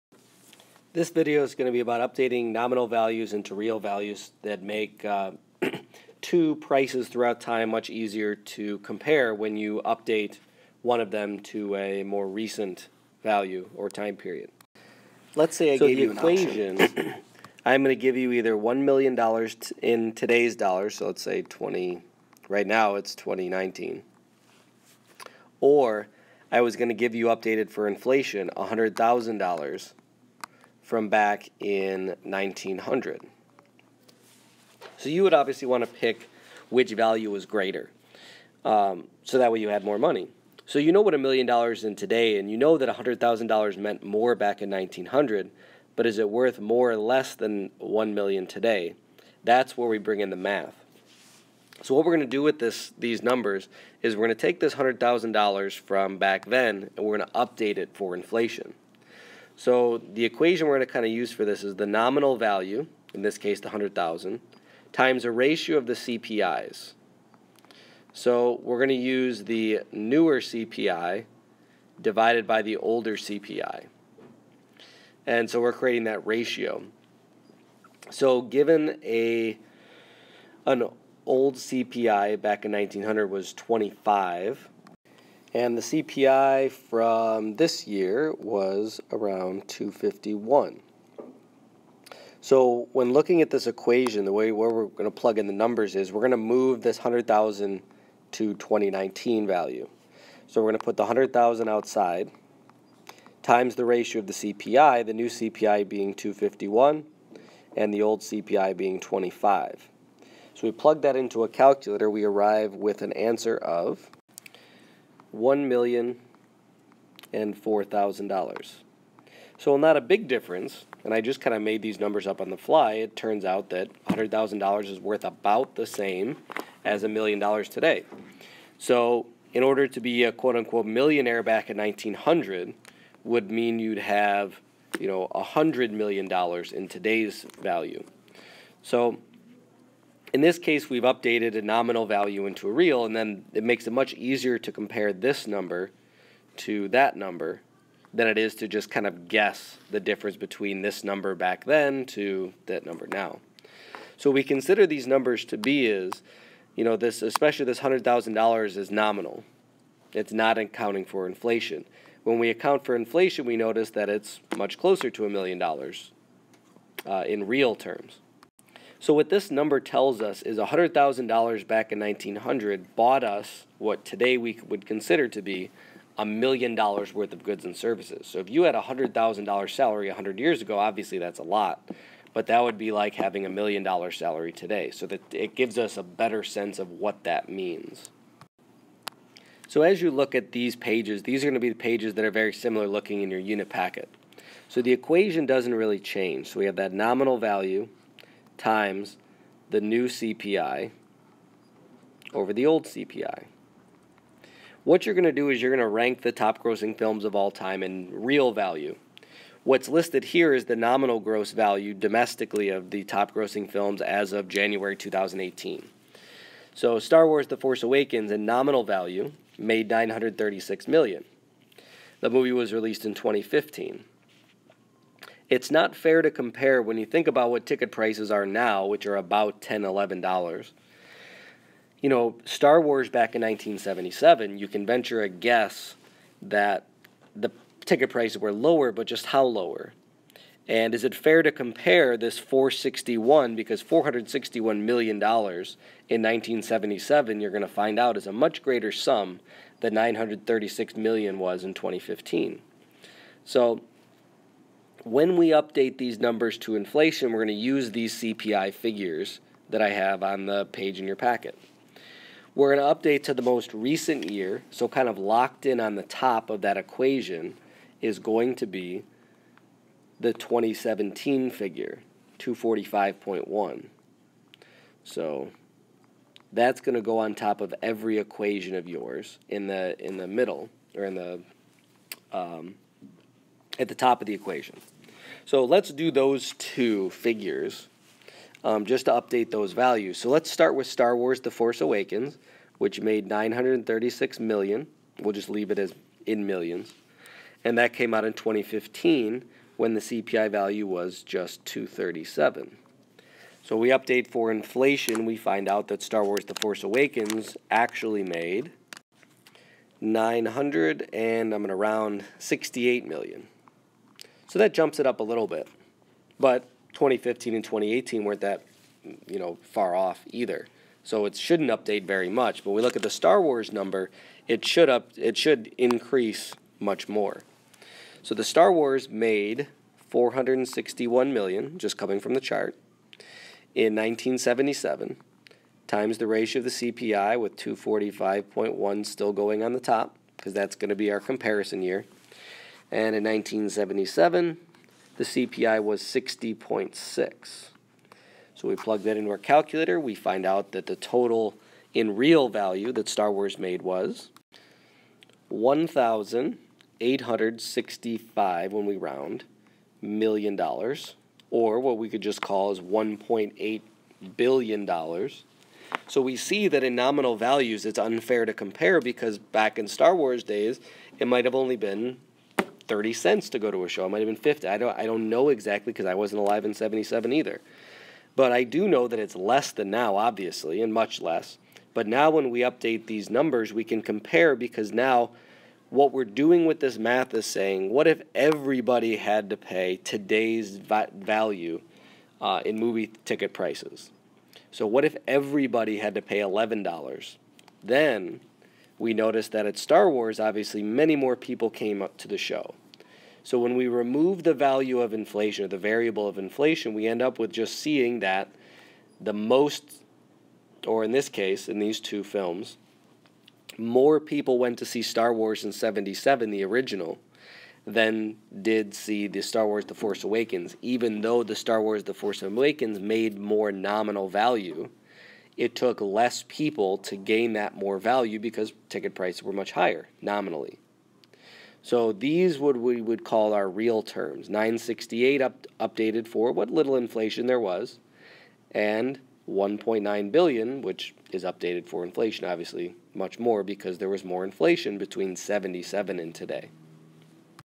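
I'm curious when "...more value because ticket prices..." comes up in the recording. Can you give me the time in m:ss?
7:07.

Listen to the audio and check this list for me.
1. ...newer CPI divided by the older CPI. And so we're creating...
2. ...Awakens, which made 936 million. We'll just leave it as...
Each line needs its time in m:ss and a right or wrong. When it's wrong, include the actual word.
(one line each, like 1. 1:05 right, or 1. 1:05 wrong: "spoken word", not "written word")
1. 1:09 right
2. 4:51 right.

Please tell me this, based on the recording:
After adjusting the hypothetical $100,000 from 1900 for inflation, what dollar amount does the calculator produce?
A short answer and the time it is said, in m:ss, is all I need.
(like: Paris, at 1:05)
$1,004,000, at 1:55.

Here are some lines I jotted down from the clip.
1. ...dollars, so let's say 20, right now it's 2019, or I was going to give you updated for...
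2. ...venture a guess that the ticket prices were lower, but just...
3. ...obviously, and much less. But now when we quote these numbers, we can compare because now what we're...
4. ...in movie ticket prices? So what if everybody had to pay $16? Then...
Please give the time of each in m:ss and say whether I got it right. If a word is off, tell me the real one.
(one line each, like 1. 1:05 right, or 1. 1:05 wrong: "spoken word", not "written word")
1. 0:20 right
2. 3:54 right
3. 6:20 wrong: "update", not "quote"
4. 6:32 wrong: "11", not "16".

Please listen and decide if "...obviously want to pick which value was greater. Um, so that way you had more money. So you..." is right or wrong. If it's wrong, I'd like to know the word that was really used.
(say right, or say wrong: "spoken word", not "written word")
right.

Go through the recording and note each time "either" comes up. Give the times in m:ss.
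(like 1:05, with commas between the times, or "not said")
0:18, 5:20, 6:17.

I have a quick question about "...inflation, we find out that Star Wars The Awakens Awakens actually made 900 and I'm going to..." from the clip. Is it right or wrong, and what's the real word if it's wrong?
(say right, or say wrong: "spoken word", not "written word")
wrong: "Force", not "Awakens".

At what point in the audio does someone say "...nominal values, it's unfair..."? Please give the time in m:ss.
6:06.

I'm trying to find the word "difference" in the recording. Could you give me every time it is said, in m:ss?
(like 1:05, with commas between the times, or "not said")
2:00, 2:29.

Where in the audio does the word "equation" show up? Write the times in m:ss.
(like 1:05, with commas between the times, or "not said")
0:16, 1:00, 1:33, 3:14, 4:26, 4:38, 4:44.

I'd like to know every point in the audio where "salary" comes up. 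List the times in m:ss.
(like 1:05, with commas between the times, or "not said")
2:59, 3:04.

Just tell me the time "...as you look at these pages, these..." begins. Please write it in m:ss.
3:09.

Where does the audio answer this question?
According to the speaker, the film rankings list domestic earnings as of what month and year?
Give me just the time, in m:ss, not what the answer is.
3:34.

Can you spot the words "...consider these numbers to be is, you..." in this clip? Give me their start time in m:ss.
2:34.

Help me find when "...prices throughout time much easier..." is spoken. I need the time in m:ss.
0:06.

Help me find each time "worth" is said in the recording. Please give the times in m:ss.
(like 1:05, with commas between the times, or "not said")
0:46, 2:04, 2:57.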